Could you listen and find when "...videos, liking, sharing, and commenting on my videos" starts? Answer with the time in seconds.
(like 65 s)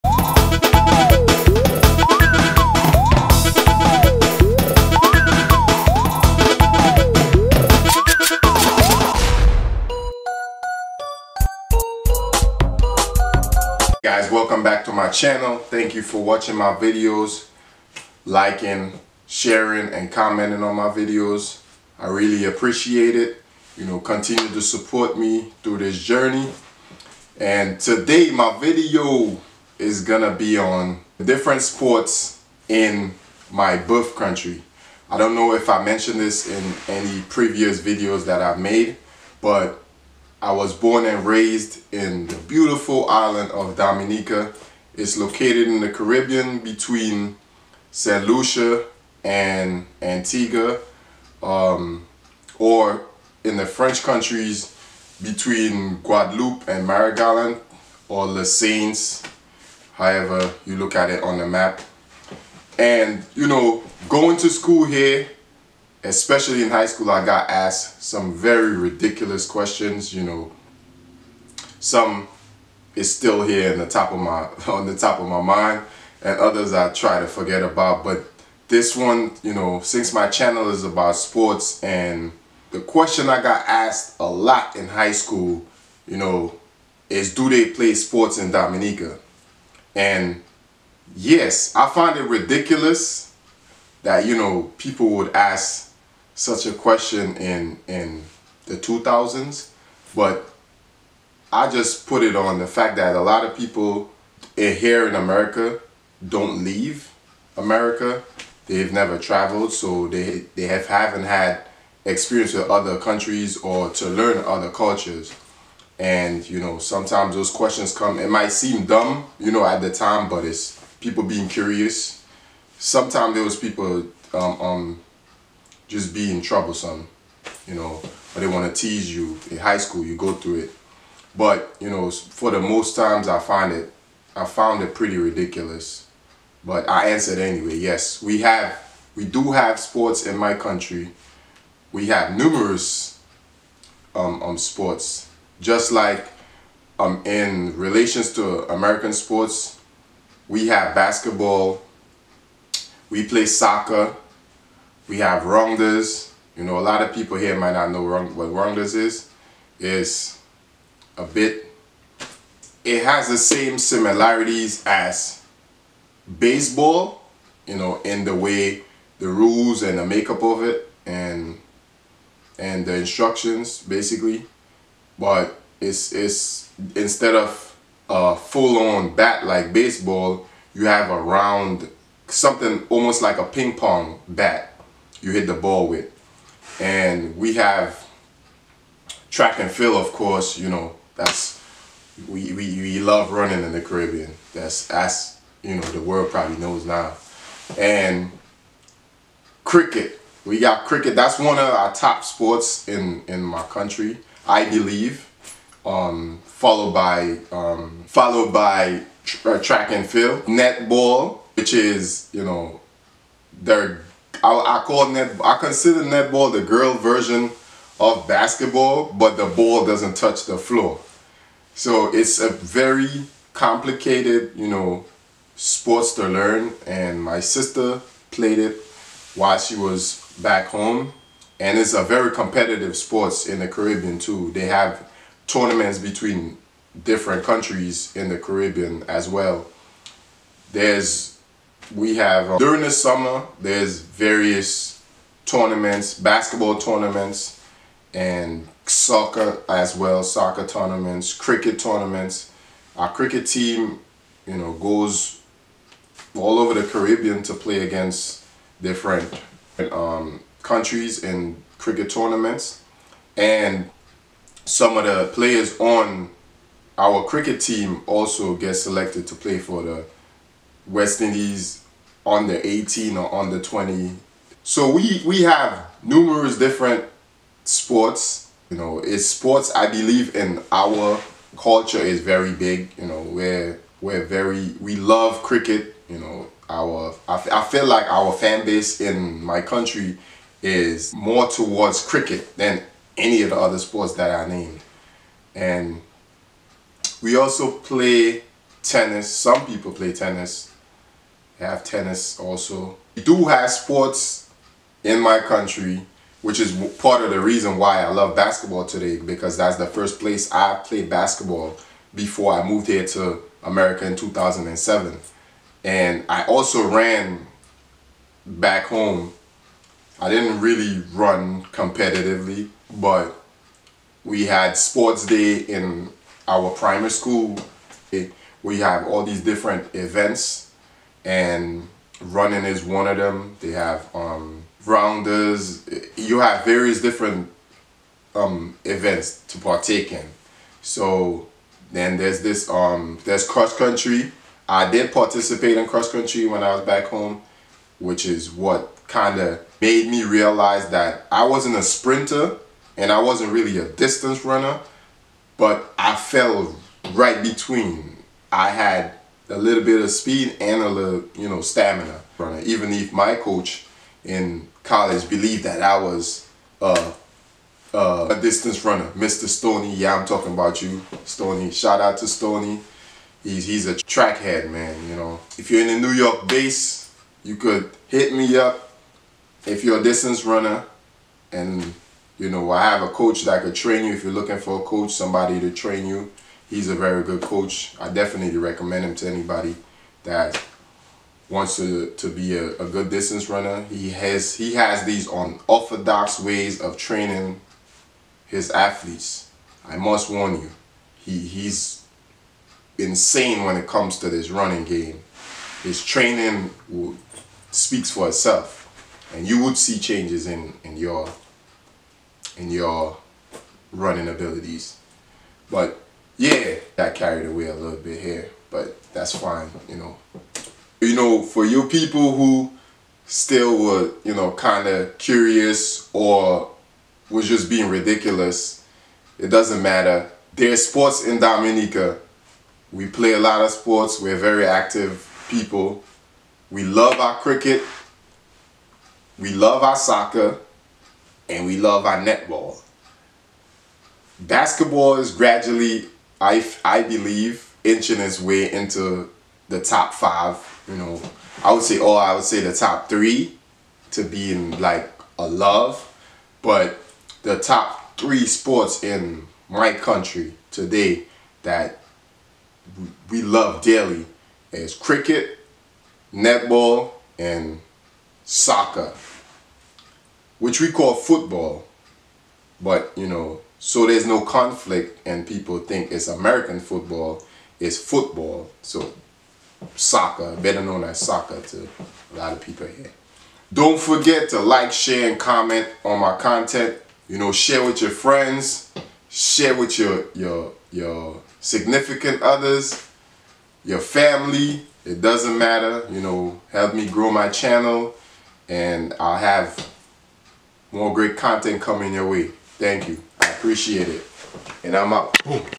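16 s.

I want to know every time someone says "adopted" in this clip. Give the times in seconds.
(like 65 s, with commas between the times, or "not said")
not said.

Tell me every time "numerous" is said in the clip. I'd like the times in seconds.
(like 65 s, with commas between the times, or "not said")
142 s, 276 s.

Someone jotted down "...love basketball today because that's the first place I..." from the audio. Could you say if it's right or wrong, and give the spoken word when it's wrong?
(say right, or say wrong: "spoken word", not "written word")
right.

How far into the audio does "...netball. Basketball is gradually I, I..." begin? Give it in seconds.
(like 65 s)
442 s.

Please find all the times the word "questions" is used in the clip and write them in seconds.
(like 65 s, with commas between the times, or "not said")
69 s, 82 s, 96 s, 117 s.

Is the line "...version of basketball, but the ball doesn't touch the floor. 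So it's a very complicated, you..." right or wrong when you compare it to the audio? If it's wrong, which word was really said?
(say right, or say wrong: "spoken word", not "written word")
right.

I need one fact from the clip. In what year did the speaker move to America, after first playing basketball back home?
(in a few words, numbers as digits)
2007.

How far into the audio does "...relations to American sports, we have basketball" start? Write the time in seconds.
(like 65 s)
147 s.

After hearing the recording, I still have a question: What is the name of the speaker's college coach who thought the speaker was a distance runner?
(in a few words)
Mr. Stoney.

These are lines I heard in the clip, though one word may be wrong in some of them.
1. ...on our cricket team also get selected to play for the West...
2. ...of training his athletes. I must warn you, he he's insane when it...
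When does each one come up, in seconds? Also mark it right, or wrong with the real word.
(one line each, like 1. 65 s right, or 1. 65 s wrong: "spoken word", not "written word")
1. 265 s right
2. 396 s right.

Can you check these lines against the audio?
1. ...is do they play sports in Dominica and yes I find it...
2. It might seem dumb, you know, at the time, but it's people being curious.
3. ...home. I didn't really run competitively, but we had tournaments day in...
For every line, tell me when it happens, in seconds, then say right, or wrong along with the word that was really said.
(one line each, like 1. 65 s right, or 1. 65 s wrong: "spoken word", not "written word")
1. 87 s right
2. 118 s right
3. 318 s wrong: "sports", not "tournaments".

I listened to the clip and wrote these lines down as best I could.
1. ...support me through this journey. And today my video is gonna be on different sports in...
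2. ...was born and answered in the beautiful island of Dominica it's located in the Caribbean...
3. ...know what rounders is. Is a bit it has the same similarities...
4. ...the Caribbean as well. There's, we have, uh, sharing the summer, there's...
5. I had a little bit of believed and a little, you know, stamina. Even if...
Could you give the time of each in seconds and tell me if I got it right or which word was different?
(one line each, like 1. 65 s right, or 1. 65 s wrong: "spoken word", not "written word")
1. 24 s right
2. 40 s wrong: "raised", not "answered"
3. 157 s right
4. 238 s wrong: "during", not "sharing"
5. 358 s wrong: "speed", not "believed".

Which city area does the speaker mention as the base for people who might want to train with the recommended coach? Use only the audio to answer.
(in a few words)
New York.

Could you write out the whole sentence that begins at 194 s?
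That's that's you know the world probably knows now.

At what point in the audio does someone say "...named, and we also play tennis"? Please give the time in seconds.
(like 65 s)
294 s.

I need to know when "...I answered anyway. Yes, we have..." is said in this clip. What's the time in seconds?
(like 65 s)
136 s.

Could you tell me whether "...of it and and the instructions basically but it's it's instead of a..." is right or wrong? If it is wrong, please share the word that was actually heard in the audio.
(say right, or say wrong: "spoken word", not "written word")
right.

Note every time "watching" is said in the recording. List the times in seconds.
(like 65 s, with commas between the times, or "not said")
16 s.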